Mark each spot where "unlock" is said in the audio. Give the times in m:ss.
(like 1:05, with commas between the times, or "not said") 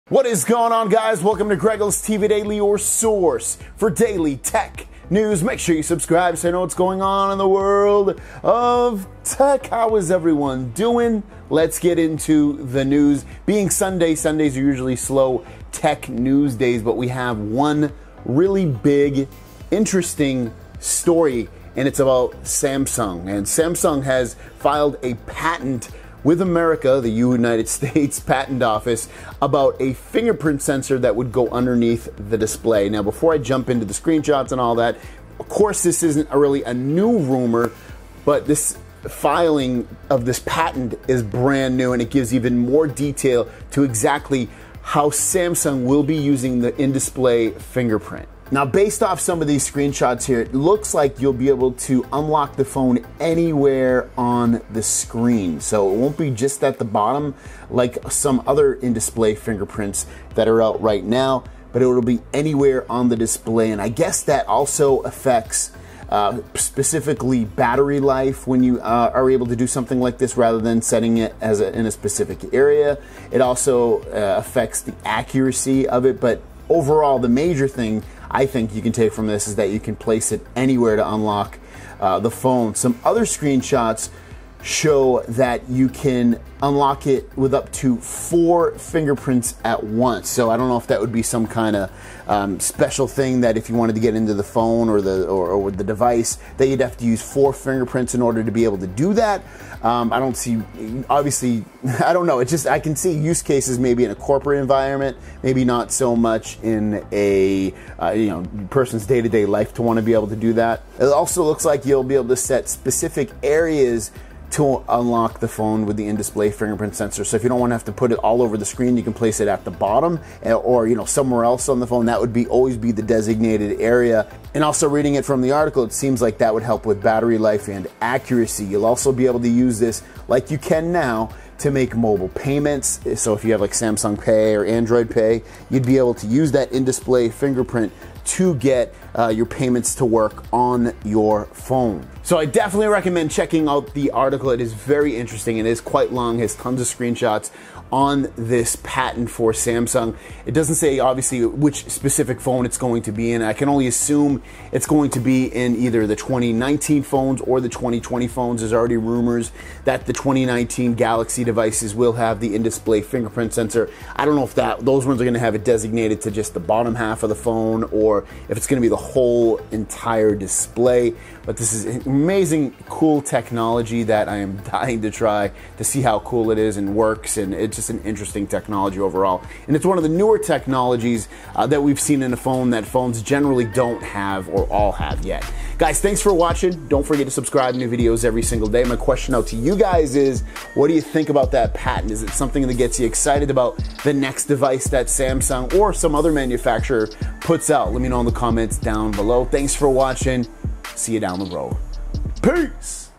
0:52, 1:21, 1:26, 1:54.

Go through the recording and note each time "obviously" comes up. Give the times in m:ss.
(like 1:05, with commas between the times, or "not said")
1:41, 2:30.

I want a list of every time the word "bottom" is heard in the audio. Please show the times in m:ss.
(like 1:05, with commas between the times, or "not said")
0:56, 1:59, 2:46.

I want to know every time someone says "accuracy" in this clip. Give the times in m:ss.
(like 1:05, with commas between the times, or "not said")
1:15, 2:08.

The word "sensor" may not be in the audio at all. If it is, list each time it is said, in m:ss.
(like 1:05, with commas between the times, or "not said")
0:30, 1:56, 2:43.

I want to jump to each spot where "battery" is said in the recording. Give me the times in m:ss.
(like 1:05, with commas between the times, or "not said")
1:07, 2:07.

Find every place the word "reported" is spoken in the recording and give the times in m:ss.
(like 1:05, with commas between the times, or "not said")
not said.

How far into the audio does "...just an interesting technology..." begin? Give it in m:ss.
2:57.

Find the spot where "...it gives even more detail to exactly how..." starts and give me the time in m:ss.
0:42.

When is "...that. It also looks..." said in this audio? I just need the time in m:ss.
1:50.